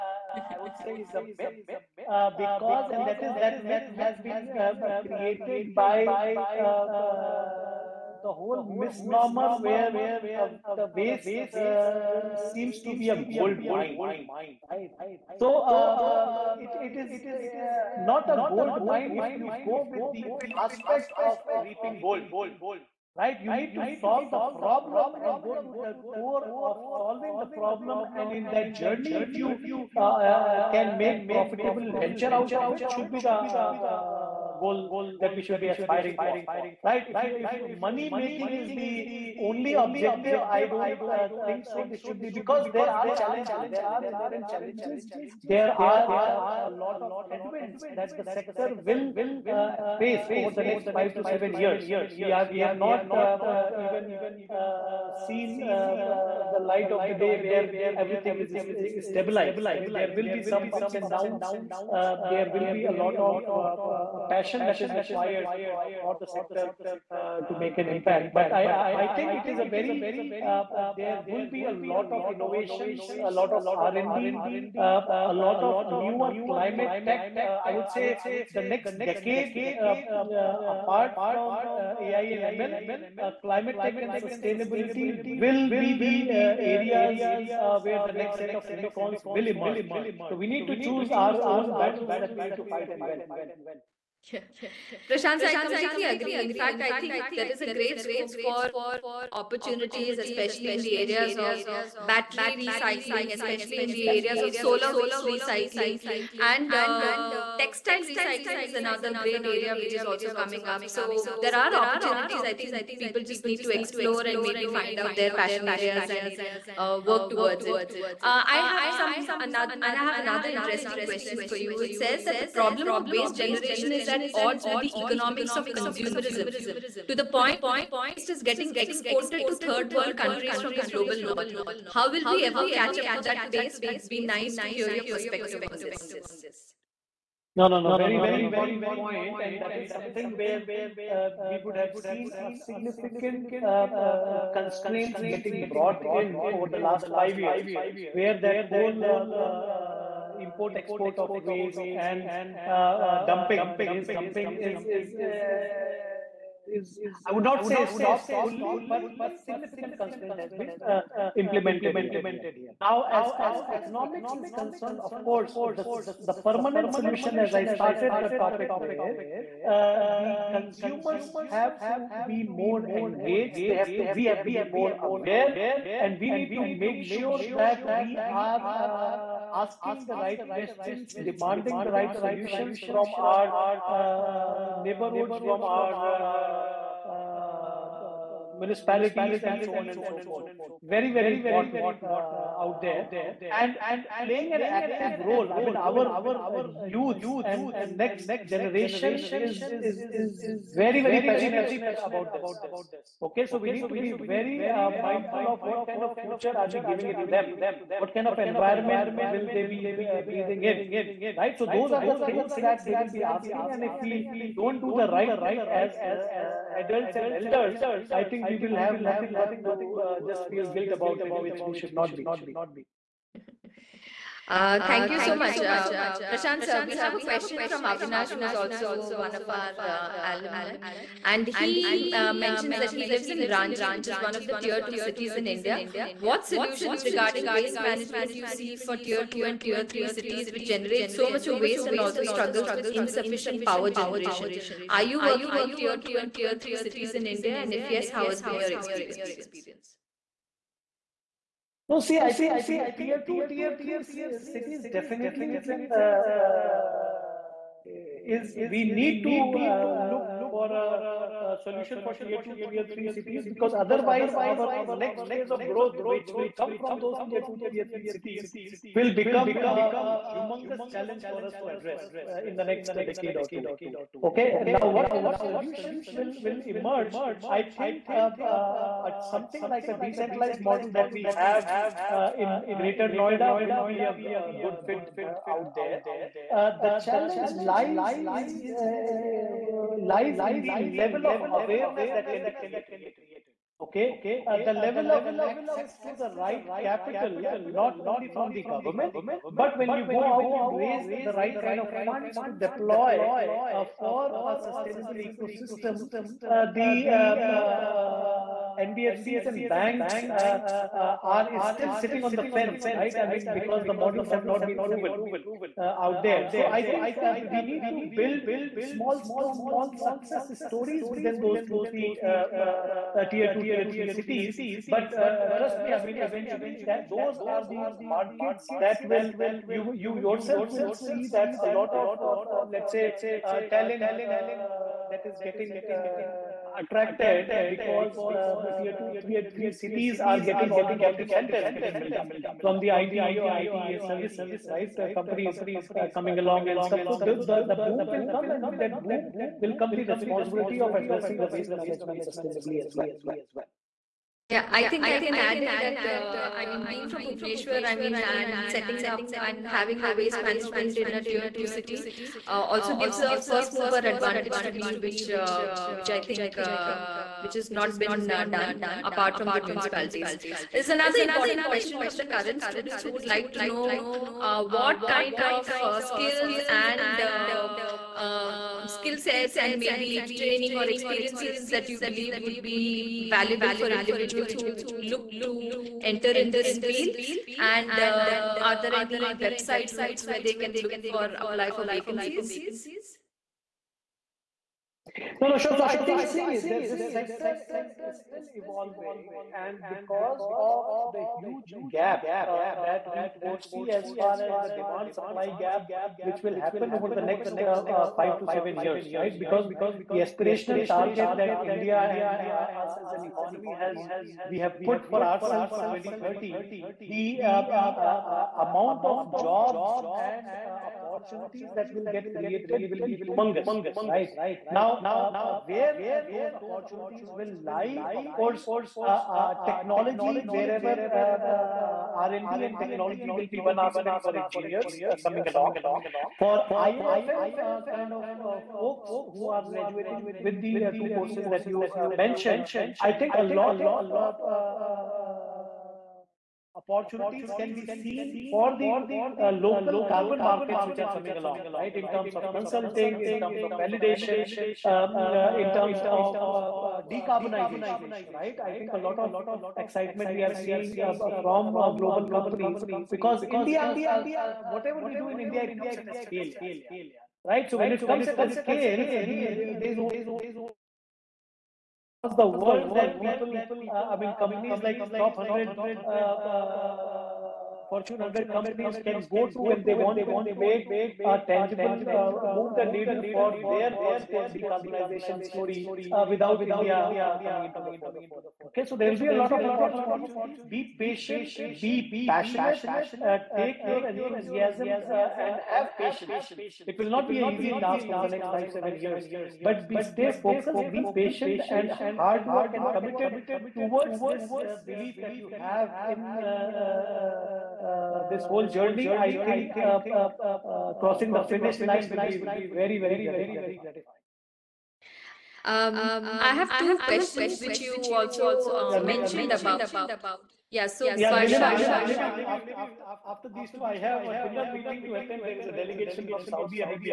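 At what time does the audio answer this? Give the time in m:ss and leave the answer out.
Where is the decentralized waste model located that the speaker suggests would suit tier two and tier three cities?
4:42.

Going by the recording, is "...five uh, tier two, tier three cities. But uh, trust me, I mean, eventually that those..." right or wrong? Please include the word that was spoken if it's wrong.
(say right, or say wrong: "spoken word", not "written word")
wrong: "three", not "five".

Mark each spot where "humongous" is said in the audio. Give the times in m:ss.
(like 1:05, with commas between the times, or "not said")
4:30, 7:03.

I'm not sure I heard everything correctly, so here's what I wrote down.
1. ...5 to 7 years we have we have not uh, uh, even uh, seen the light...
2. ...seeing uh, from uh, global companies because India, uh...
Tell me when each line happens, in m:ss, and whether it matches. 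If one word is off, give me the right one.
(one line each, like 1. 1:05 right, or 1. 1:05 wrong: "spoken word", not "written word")
1. 0:50 right
2. 7:40 right.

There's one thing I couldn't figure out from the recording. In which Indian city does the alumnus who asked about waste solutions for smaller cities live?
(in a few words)
Ranchi.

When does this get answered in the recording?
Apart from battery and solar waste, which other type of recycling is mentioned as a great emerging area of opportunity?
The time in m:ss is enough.
1:47.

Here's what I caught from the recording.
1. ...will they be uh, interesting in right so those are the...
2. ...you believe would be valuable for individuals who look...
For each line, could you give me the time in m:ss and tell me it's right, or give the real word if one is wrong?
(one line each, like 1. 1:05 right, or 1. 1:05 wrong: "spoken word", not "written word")
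1. 3:29 wrong: "breathing", not "interesting"
2. 6:21 right.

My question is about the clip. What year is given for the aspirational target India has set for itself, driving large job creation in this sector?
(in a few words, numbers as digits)
2030.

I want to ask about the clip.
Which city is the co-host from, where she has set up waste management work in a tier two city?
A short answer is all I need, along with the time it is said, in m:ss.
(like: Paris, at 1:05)
Bhubaneswar, at 5:57.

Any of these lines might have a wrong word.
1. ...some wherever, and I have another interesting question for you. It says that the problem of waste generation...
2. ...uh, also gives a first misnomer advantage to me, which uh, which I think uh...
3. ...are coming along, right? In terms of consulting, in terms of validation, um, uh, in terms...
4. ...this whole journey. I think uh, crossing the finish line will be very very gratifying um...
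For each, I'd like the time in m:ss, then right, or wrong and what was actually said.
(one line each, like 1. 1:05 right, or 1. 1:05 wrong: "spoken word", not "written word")
1. 1:58 wrong: "another", not "wherever"
2. 6:02 wrong: "mover", not "misnomer"
3. 7:30 right
4. 8:28 right.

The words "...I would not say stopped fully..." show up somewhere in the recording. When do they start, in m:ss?
2:37.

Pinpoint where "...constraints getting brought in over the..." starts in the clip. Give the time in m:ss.
2:24.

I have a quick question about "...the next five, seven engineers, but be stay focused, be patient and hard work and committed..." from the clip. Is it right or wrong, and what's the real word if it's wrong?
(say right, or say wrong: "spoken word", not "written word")
wrong: "years", not "engineers".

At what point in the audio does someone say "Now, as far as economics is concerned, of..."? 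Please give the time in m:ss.
2:42.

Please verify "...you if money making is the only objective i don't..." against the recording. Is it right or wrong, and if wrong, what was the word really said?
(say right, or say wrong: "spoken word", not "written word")
right.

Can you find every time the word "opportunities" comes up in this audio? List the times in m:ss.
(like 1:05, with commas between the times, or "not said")
1:39, 1:51, 7:00, 7:06, 7:26, 8:09.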